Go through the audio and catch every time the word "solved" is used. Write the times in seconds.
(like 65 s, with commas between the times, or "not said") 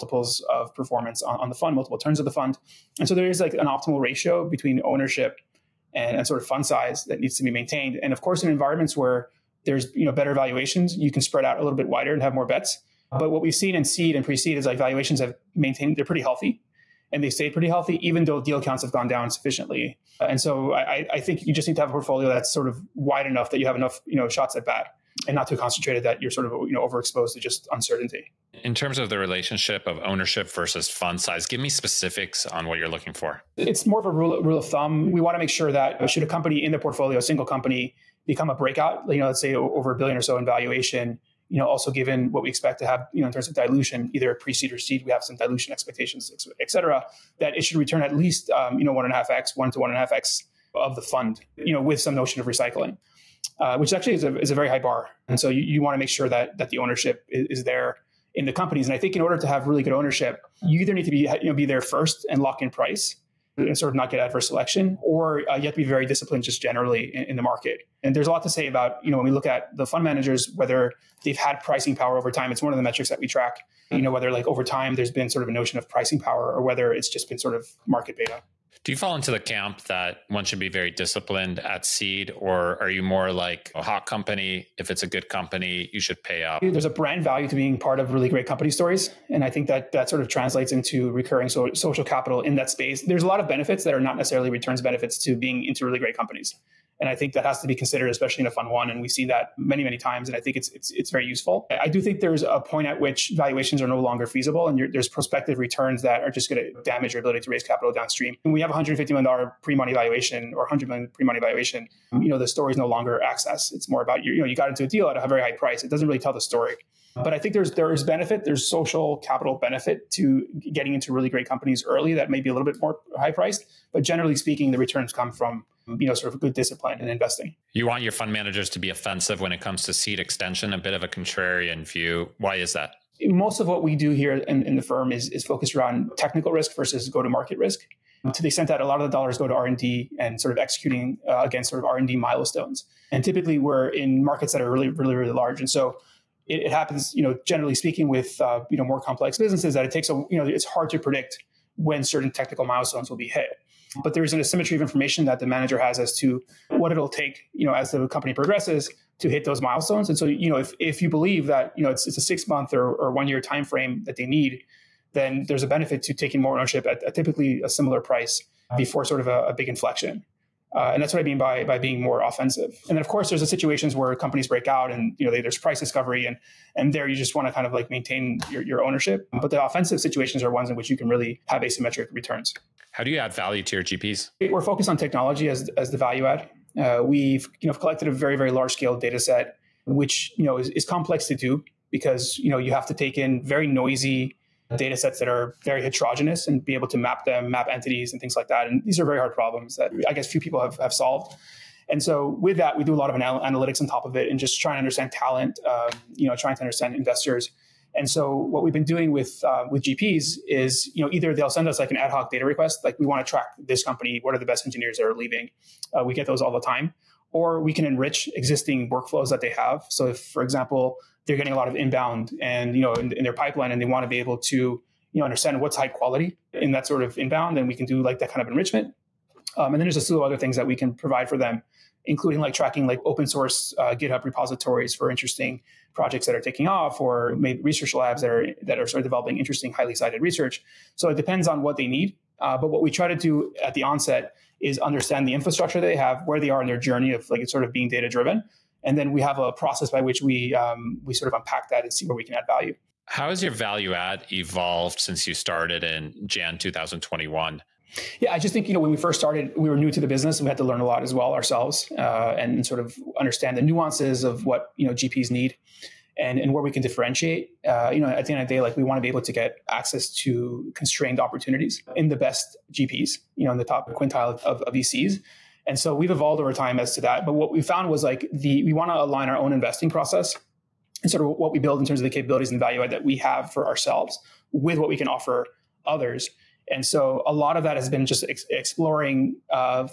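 200 s.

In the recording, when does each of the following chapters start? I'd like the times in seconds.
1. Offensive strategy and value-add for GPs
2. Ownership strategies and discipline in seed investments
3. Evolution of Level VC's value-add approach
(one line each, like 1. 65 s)
1. 127 s
2. 27 s
3. 252 s.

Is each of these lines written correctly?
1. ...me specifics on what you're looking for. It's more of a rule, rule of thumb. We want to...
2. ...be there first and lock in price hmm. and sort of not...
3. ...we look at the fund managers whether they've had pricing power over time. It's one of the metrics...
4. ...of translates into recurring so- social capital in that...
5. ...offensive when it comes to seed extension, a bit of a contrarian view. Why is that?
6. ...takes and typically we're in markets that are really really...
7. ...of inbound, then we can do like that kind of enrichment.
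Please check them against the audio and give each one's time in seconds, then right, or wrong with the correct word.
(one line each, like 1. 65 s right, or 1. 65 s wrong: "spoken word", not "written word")
1. 31 s right
2. 61 s right
3. 69 s right
4. 90 s right
5. 128 s right
6. 142 s wrong: "milestones", not "takes"
7. 227 s right.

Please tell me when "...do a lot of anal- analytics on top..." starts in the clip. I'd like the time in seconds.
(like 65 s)
202 s.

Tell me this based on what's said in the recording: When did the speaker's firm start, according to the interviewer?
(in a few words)
January 2021.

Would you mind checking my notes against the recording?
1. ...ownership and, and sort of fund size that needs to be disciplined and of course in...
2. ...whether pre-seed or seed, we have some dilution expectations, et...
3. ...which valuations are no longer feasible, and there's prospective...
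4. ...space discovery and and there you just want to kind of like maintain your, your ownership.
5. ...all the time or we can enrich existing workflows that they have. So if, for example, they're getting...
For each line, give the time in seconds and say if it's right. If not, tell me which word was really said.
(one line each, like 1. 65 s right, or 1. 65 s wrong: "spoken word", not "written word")
1. 4 s wrong: "maintained", not "disciplined"
2. 44 s wrong: "either", not "whether"
3. 103 s right
4. 175 s wrong: "price", not "space"
5. 216 s right.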